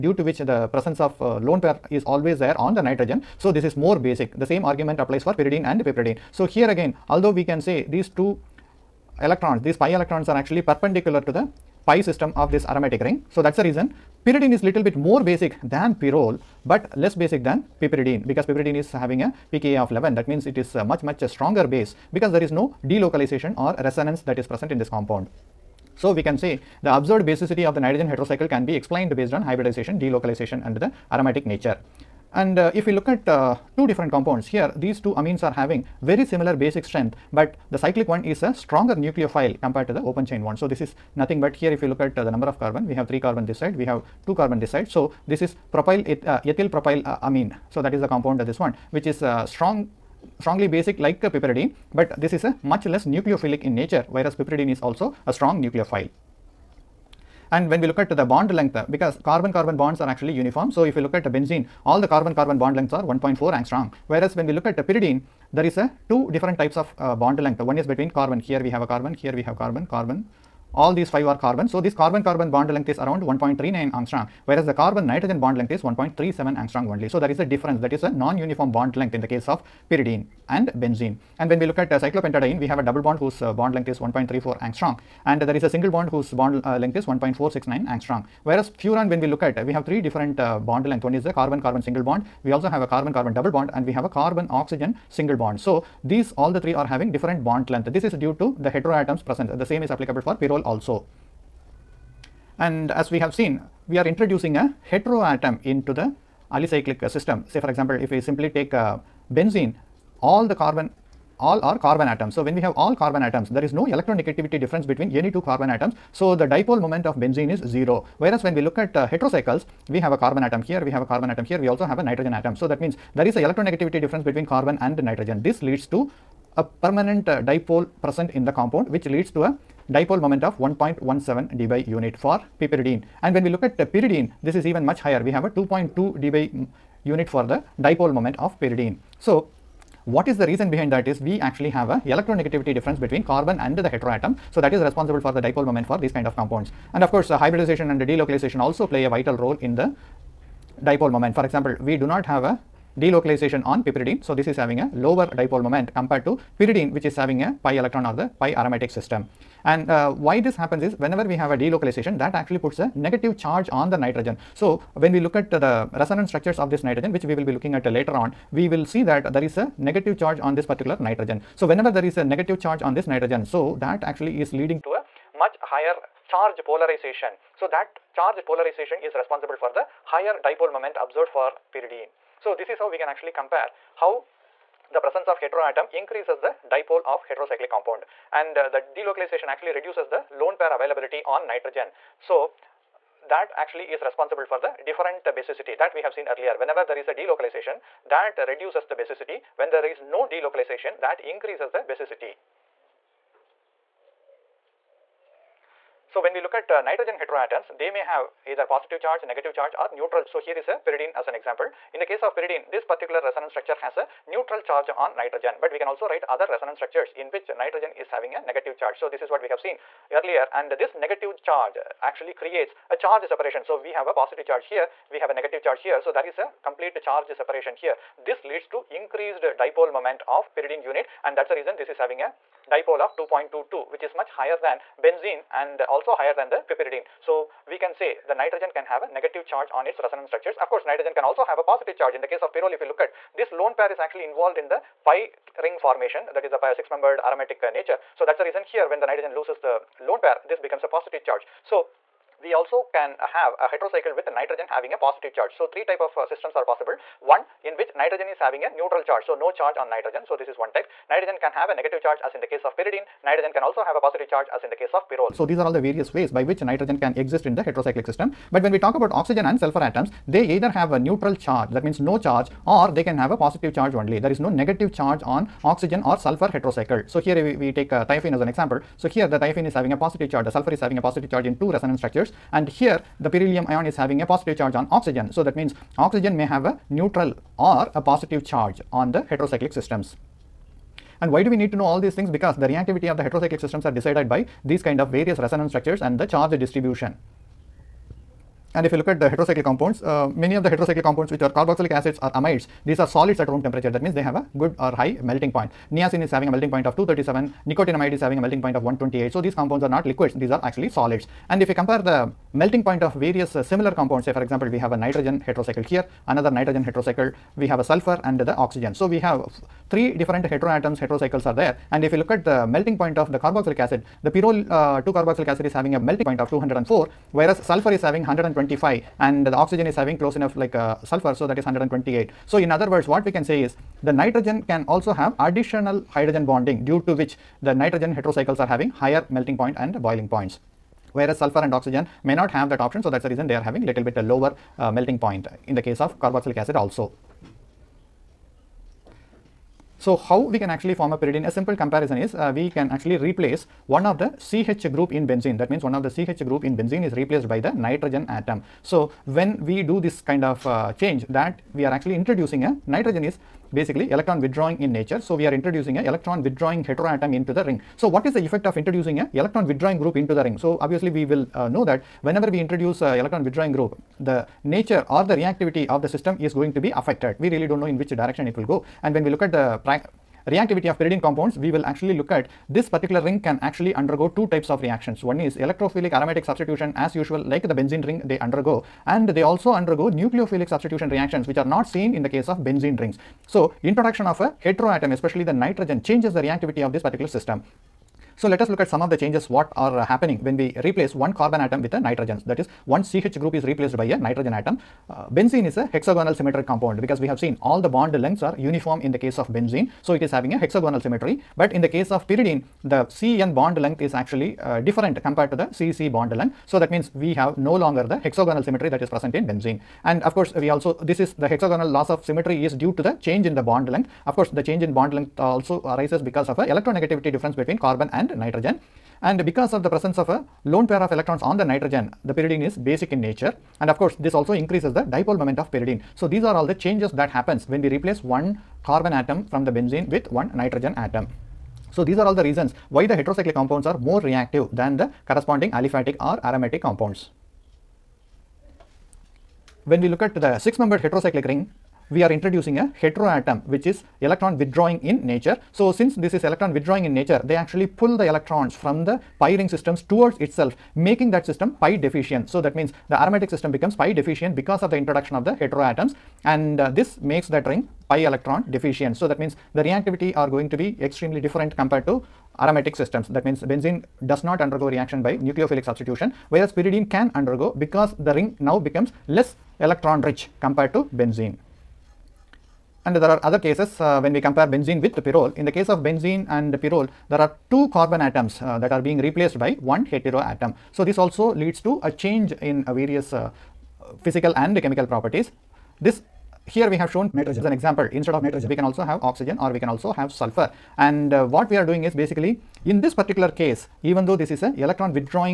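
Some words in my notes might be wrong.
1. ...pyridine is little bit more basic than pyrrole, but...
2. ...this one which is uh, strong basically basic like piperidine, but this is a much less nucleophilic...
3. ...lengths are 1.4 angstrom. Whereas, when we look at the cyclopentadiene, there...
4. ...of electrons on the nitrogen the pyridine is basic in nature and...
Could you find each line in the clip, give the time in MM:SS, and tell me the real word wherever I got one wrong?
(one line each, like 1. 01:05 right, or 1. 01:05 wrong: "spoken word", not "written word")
1. 00:14 right
2. 00:48 wrong: "strongly", not "basically"
3. 01:02 wrong: "pyridine", not "cyclopentadiene"
4. 07:11 right.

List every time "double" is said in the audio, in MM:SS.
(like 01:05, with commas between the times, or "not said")
01:22, 01:33.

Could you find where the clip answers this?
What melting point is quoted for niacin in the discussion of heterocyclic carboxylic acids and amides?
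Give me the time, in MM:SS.
05:06.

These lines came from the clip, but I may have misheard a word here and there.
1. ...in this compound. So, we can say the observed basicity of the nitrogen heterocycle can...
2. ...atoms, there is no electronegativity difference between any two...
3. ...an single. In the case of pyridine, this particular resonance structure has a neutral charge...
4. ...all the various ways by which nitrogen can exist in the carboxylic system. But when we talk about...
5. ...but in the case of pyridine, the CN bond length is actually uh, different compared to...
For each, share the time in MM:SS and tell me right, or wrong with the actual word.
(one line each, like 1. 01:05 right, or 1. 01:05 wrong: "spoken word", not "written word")
1. 00:24 right
2. 01:53 right
3. 03:31 wrong: "example", not "single"
4. 04:25 wrong: "heterocyclic", not "carboxylic"
5. 06:51 right.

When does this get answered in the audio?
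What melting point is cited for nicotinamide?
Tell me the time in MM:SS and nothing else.
05:07.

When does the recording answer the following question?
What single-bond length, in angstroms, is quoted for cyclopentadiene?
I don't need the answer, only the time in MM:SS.
01:27.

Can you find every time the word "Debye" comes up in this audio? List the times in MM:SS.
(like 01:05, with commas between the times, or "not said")
02:11, 02:15.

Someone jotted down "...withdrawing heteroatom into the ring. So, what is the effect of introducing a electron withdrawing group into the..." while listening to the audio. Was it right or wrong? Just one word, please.
right.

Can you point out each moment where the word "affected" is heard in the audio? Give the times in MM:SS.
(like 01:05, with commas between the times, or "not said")
06:16.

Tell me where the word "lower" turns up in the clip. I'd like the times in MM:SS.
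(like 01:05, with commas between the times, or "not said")
02:34, 05:44.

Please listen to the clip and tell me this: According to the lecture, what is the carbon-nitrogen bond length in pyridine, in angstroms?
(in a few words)
1.37.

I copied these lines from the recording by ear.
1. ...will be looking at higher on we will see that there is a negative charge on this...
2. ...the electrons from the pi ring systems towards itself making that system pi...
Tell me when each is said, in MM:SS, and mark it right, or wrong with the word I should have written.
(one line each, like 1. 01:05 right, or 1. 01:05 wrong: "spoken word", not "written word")
1. 02:47 wrong: "later", not "higher"
2. 07:38 right.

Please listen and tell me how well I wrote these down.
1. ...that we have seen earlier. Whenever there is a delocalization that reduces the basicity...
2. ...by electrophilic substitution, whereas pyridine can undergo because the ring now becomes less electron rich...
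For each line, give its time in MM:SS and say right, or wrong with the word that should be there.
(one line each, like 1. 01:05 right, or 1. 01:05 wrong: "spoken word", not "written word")
1. 03:15 right
2. 07:55 wrong: "nucleophilic", not "electrophilic".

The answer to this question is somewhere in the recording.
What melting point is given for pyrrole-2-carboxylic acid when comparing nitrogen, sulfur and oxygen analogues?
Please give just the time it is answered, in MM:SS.
05:26.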